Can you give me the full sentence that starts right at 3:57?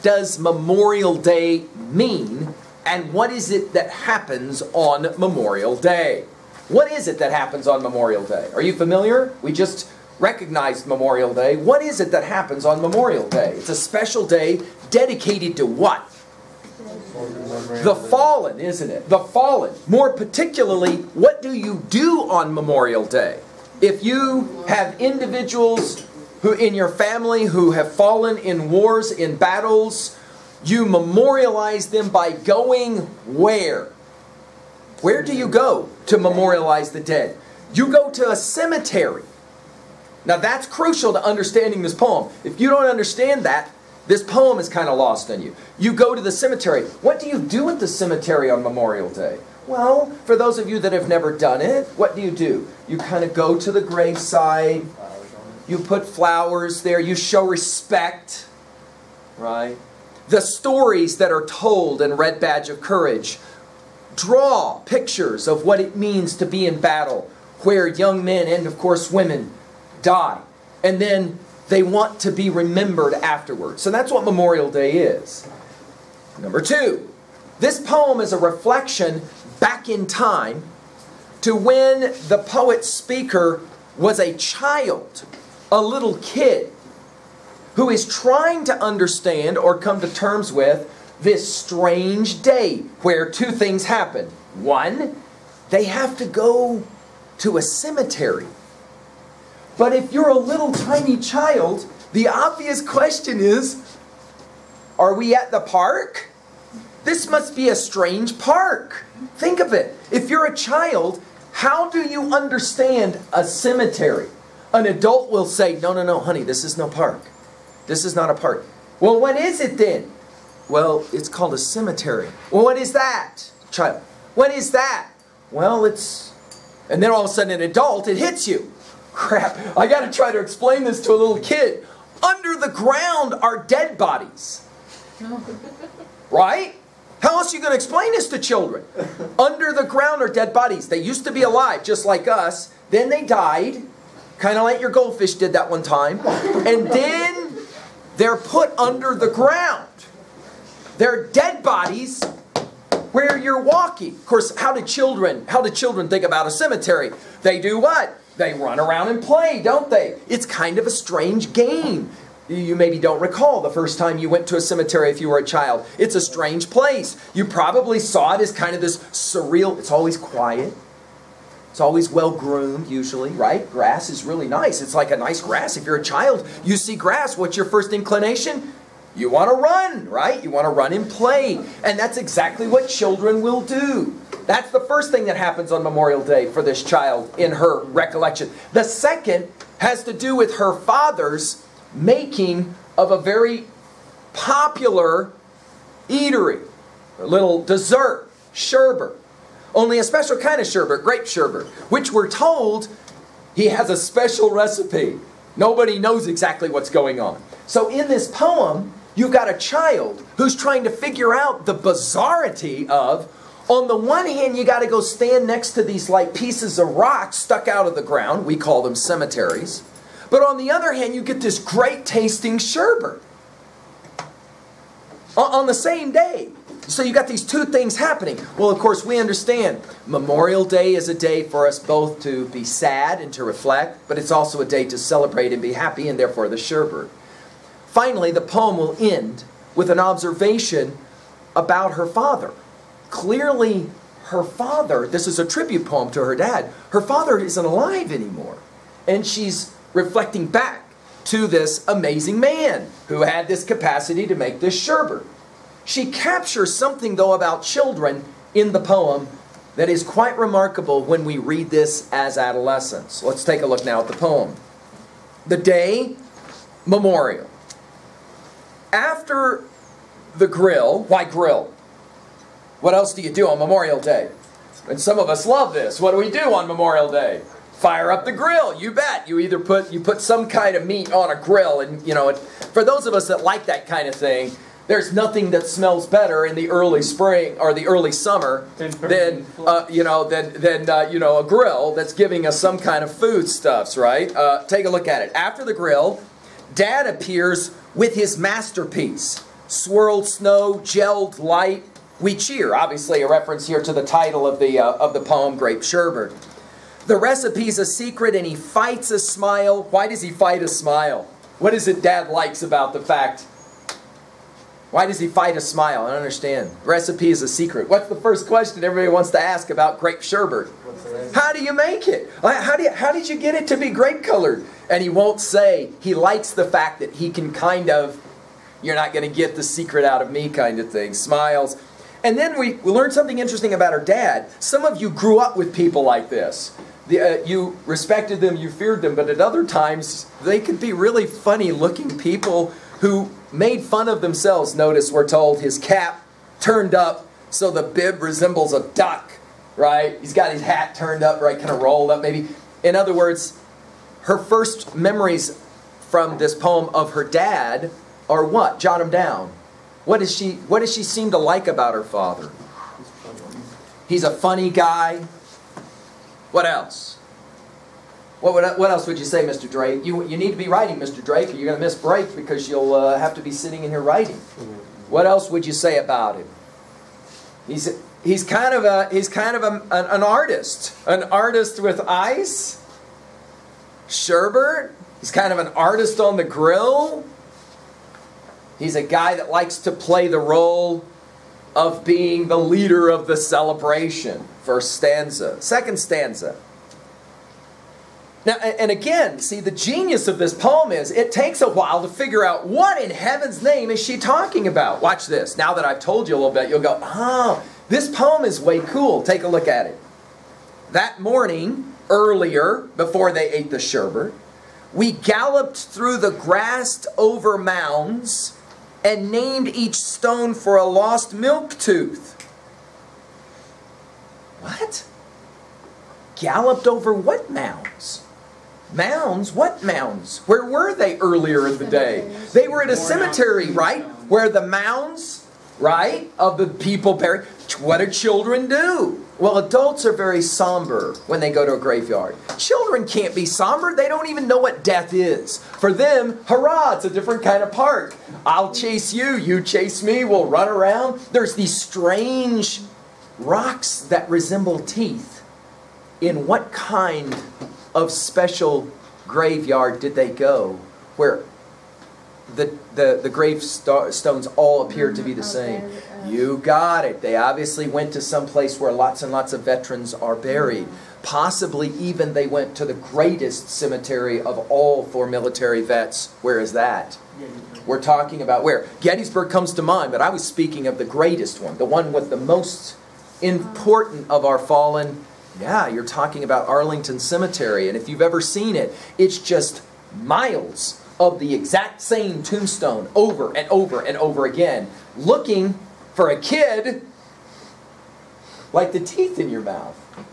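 Finally, the poem will end with an observation about her father.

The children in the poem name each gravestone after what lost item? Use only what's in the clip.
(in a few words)
milk tooth.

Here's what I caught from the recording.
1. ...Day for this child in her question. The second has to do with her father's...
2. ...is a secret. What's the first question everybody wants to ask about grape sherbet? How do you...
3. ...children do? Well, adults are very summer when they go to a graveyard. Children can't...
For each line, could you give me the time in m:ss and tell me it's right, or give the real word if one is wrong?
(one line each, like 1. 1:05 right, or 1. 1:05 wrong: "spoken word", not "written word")
1. 3:06 wrong: "recollection", not "question"
2. 5:17 right
3. 7:18 wrong: "somber", not "summer".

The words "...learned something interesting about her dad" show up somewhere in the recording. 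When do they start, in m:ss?
5:32.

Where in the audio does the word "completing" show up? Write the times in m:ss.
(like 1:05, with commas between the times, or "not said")
not said.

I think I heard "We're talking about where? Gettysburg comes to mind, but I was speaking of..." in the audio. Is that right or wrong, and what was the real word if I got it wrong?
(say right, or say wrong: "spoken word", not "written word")
right.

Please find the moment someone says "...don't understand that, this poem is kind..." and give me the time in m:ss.
0:42.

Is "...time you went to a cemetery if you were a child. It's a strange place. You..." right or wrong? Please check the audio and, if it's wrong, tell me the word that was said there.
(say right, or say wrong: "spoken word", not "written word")
right.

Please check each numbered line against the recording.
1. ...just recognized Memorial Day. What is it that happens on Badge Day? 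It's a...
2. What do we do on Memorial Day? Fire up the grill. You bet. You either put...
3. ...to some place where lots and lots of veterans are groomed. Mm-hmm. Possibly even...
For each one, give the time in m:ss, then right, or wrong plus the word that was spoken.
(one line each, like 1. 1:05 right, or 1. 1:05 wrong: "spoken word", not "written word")
1. 0:09 wrong: "Memorial", not "Badge"
2. 4:35 right
3. 7:48 wrong: "buried", not "groomed".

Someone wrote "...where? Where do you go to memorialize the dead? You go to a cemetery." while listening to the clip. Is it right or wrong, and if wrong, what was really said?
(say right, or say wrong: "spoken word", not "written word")
right.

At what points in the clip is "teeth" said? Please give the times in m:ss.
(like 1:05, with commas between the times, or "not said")
7:34, 8:18.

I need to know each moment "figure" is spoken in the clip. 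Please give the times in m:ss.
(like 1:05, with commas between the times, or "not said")
3:30, 6:42.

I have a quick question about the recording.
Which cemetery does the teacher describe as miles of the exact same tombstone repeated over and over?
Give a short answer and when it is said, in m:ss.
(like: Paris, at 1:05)
Arlington Cemetery, at 8:06.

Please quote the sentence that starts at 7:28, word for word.
I'll chase you, you chase me, we'll run around.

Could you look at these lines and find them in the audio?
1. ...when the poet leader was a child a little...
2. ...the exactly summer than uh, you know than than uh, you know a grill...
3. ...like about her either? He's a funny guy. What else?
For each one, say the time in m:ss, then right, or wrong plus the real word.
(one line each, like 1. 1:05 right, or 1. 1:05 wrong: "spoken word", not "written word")
1. 1:21 wrong: "speaker", not "leader"
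2. 4:47 wrong: "early", not "exactly"
3. 6:01 wrong: "father", not "either".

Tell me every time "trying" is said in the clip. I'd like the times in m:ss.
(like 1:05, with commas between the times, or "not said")
1:28, 3:30.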